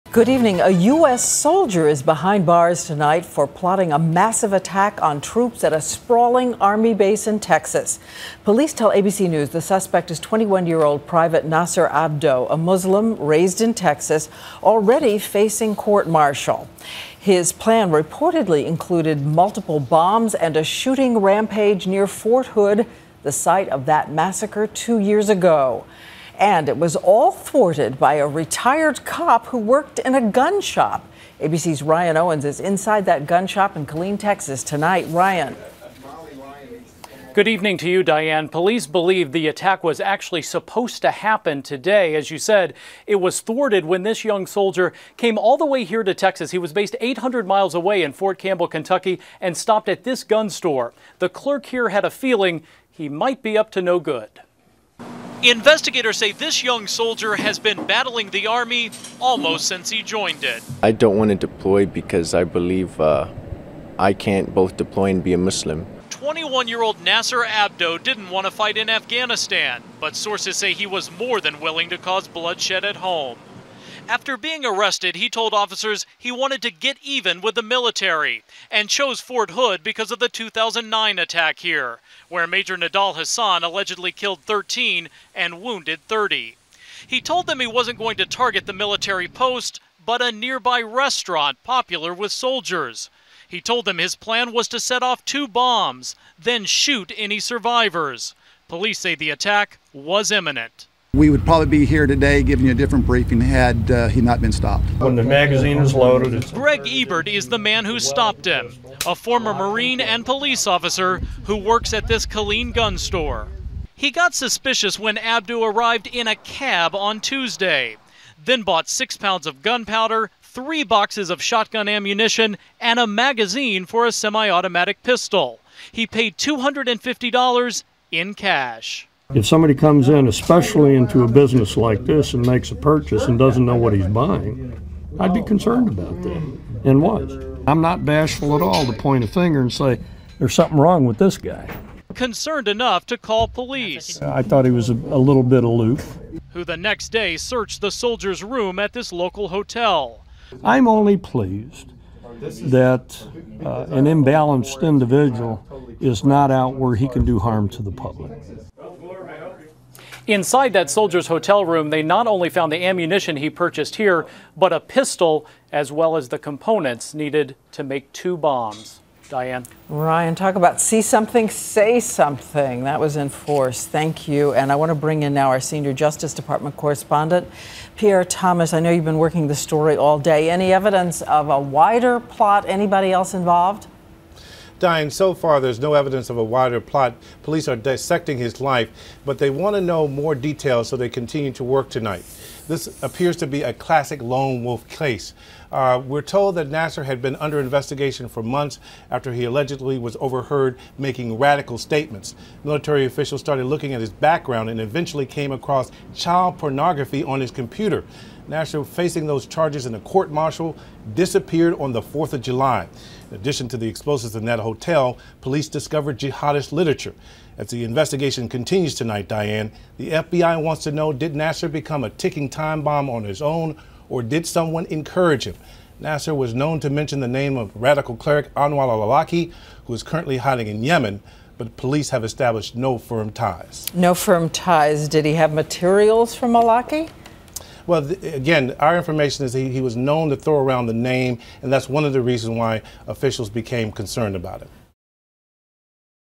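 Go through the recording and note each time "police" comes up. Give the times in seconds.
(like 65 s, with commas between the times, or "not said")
8 s, 38 s, 98 s, 110 s, 143 s, 187 s, 215 s, 231 s.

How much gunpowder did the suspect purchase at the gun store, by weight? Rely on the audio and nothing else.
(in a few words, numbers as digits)
6 pounds.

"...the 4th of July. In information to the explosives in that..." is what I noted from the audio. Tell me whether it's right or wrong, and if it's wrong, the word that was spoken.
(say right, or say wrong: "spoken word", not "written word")
wrong: "addition", not "information".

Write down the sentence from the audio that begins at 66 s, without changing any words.
21-year-old Naser Abdo didn't want to fight in Afghanistan, but sources say he was more than willing to cause bloodshed at home.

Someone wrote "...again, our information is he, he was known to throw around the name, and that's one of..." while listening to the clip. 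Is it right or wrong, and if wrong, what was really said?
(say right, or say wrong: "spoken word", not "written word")
right.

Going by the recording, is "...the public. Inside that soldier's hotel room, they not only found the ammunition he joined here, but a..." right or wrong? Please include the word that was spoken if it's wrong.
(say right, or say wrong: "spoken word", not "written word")
wrong: "purchased", not "joined".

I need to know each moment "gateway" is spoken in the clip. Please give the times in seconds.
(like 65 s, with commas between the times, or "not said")
not said.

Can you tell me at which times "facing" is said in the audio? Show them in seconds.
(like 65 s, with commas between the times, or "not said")
15 s, 208 s.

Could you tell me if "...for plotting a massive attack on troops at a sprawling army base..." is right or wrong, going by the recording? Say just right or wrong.
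right.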